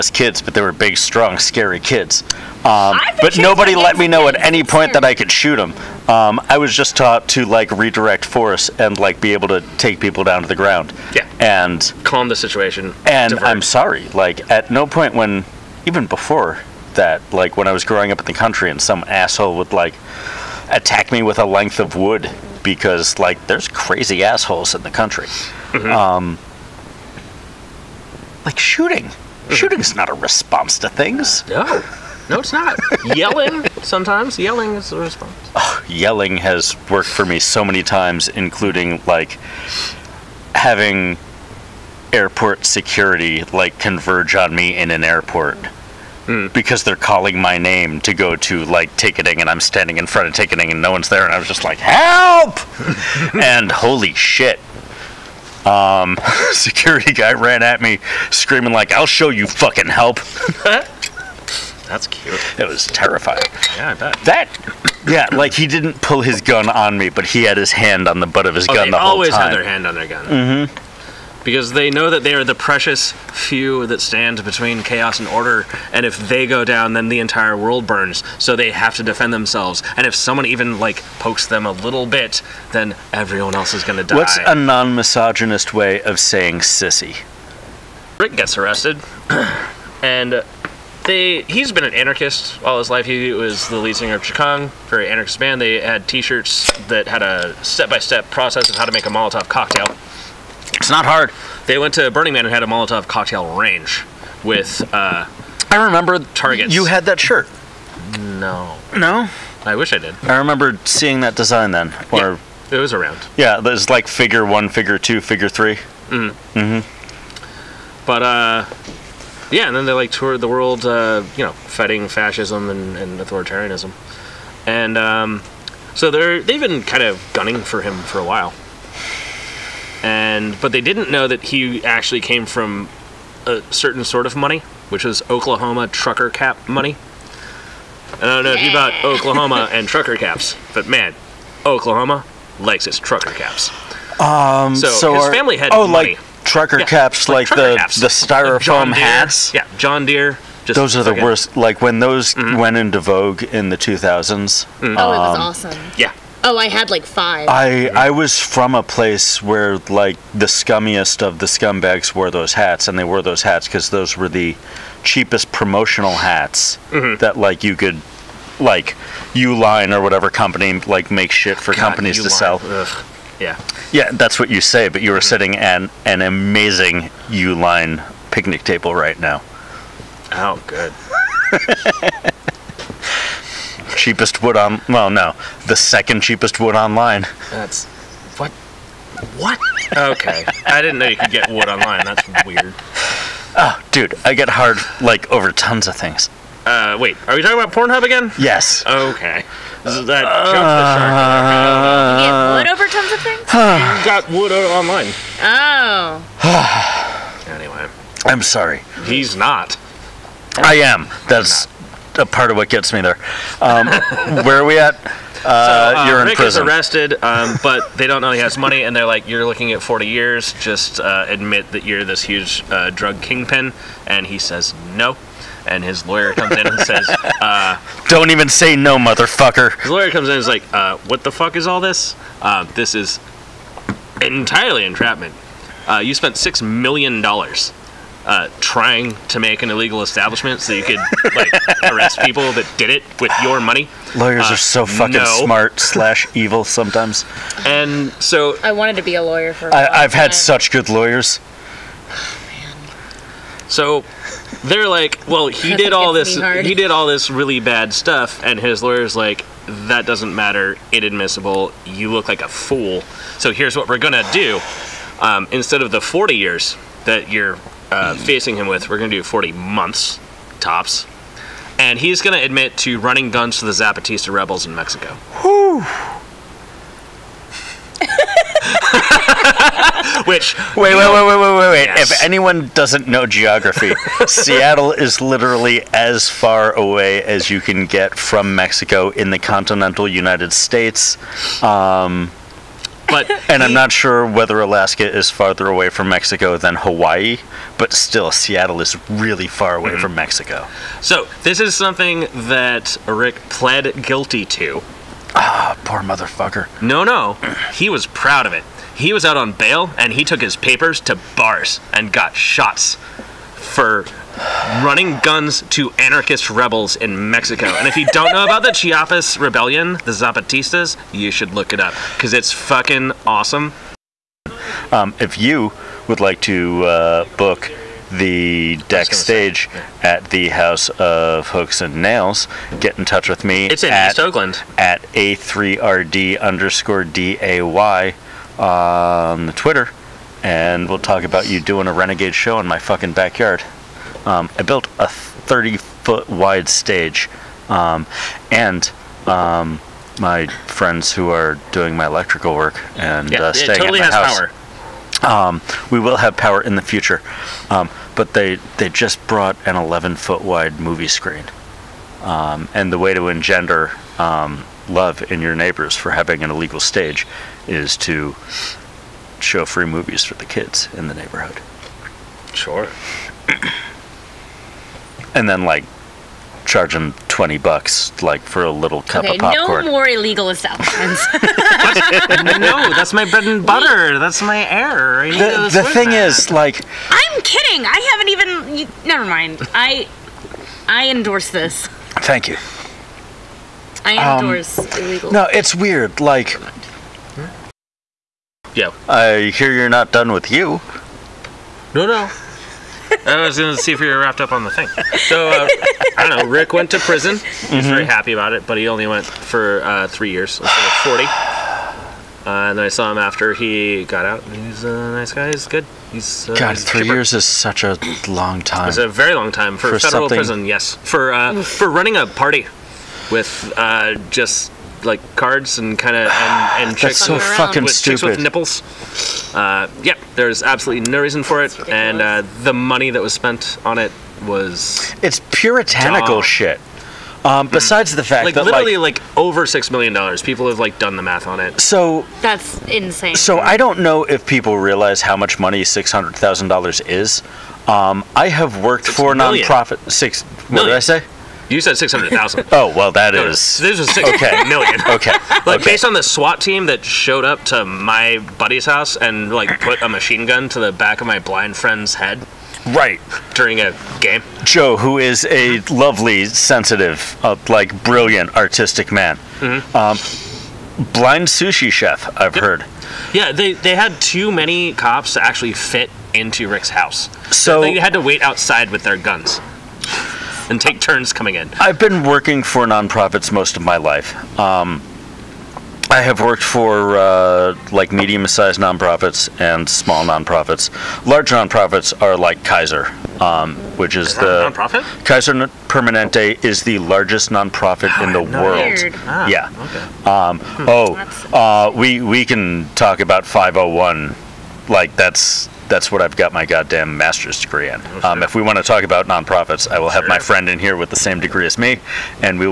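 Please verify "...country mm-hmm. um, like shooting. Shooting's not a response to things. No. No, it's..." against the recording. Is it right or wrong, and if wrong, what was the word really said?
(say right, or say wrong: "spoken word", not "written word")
right.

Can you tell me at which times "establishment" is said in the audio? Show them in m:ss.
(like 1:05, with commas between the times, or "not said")
4:00, 6:20.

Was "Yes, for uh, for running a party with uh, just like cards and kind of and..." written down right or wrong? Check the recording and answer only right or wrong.
right.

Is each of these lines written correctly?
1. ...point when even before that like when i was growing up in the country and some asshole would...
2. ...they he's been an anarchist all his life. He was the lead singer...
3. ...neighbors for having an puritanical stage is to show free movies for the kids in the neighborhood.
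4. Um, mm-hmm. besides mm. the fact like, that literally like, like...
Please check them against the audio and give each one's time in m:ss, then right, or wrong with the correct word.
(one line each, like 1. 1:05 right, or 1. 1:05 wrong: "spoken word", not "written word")
1. 0:14 right
2. 1:31 right
3. 6:05 wrong: "illegal", not "puritanical"
4. 7:17 right.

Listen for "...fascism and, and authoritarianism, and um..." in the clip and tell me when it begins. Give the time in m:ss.
2:02.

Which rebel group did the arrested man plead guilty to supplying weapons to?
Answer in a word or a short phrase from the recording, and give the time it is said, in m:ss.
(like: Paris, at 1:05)
Zapatista rebels, at 4:33.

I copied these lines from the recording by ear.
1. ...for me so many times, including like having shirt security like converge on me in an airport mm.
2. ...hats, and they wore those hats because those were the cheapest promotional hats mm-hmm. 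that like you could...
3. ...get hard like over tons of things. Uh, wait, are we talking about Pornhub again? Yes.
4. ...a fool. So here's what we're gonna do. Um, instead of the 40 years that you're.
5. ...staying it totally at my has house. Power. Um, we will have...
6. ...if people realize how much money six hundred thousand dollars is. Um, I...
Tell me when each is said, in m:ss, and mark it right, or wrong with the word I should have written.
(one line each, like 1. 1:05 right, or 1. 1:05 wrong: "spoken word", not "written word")
1. 0:37 wrong: "airport", not "shirt"
2. 2:42 right
3. 3:14 right
4. 4:22 right
5. 5:53 right
6. 7:24 right.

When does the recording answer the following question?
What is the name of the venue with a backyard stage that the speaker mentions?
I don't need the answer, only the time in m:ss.
5:30.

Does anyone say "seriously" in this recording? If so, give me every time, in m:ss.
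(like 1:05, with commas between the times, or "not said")
not said.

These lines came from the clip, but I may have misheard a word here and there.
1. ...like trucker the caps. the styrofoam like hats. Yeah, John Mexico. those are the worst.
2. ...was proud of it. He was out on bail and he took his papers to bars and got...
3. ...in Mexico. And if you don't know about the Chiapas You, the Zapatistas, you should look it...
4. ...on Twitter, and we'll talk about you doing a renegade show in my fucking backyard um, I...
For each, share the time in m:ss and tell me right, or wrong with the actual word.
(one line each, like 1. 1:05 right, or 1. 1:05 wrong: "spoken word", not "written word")
1. 2:27 wrong: "Deere", not "Mexico"
2. 5:07 right
3. 5:16 wrong: "Rebellion", not "You"
4. 5:38 right.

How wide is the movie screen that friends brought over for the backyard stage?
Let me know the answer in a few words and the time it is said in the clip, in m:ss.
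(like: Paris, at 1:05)
11 feet, at 5:59.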